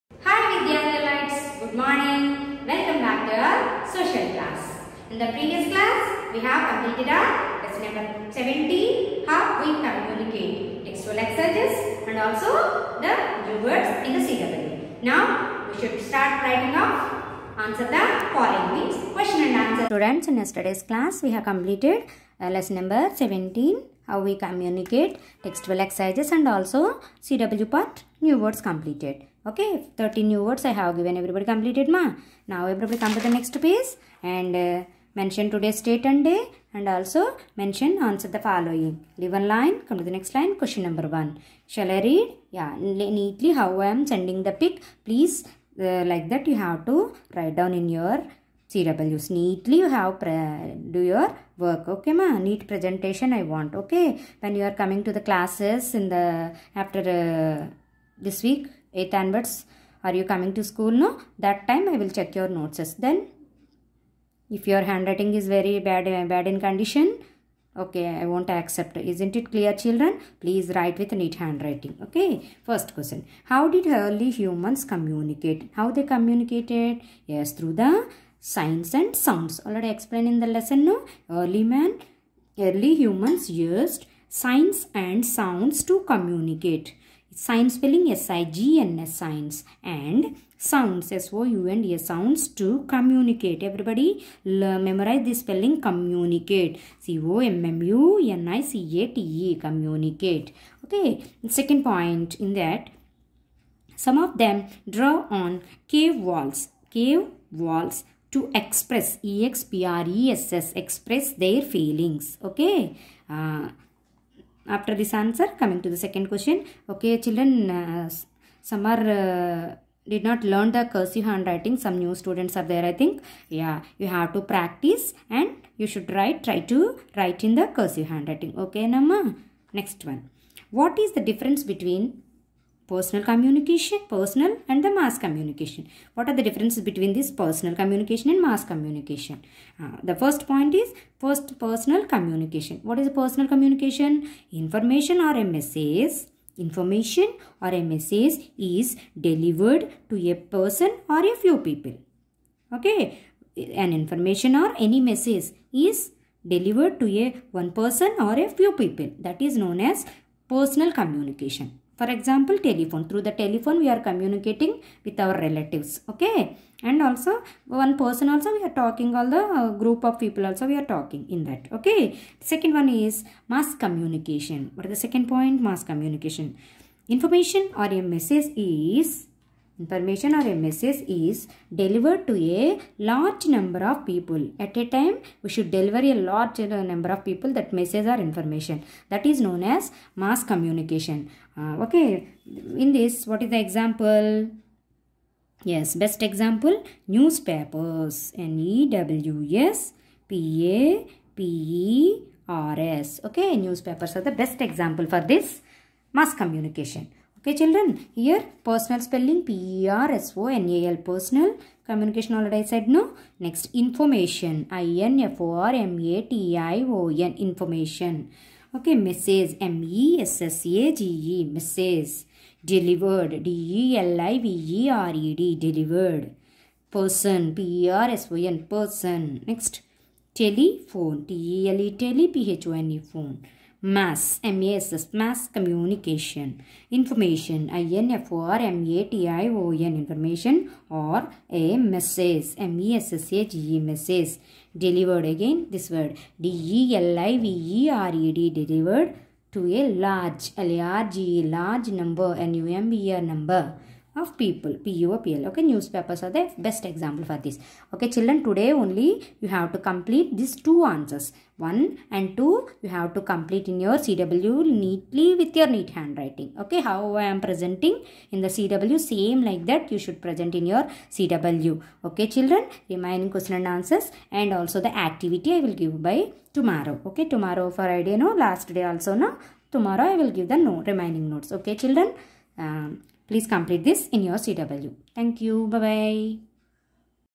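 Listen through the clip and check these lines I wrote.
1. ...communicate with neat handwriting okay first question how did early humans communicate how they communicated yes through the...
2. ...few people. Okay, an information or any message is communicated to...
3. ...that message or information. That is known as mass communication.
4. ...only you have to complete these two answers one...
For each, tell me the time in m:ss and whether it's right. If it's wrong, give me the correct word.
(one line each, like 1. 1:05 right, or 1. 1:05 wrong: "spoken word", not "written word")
1. 1:10 wrong: "write", not "communicate"
2. 2:31 wrong: "delivered", not "communicated"
3. 3:07 right
4. 4:18 right.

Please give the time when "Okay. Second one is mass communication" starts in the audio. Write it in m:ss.
2:51.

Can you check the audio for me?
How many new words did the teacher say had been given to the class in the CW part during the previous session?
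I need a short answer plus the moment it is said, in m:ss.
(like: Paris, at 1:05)
30, at 0:29.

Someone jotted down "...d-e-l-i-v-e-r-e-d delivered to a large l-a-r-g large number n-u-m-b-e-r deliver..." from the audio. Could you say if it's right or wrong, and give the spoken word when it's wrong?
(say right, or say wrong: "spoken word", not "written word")
wrong: "number", not "deliver".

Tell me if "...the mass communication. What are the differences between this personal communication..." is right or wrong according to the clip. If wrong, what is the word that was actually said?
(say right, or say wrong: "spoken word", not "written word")
right.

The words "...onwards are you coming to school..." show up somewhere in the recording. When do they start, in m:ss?
0:59.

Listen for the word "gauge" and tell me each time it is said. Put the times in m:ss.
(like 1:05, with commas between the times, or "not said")
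not said.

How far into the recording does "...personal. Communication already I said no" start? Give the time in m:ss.
3:30.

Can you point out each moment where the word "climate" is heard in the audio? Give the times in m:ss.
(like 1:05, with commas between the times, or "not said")
not said.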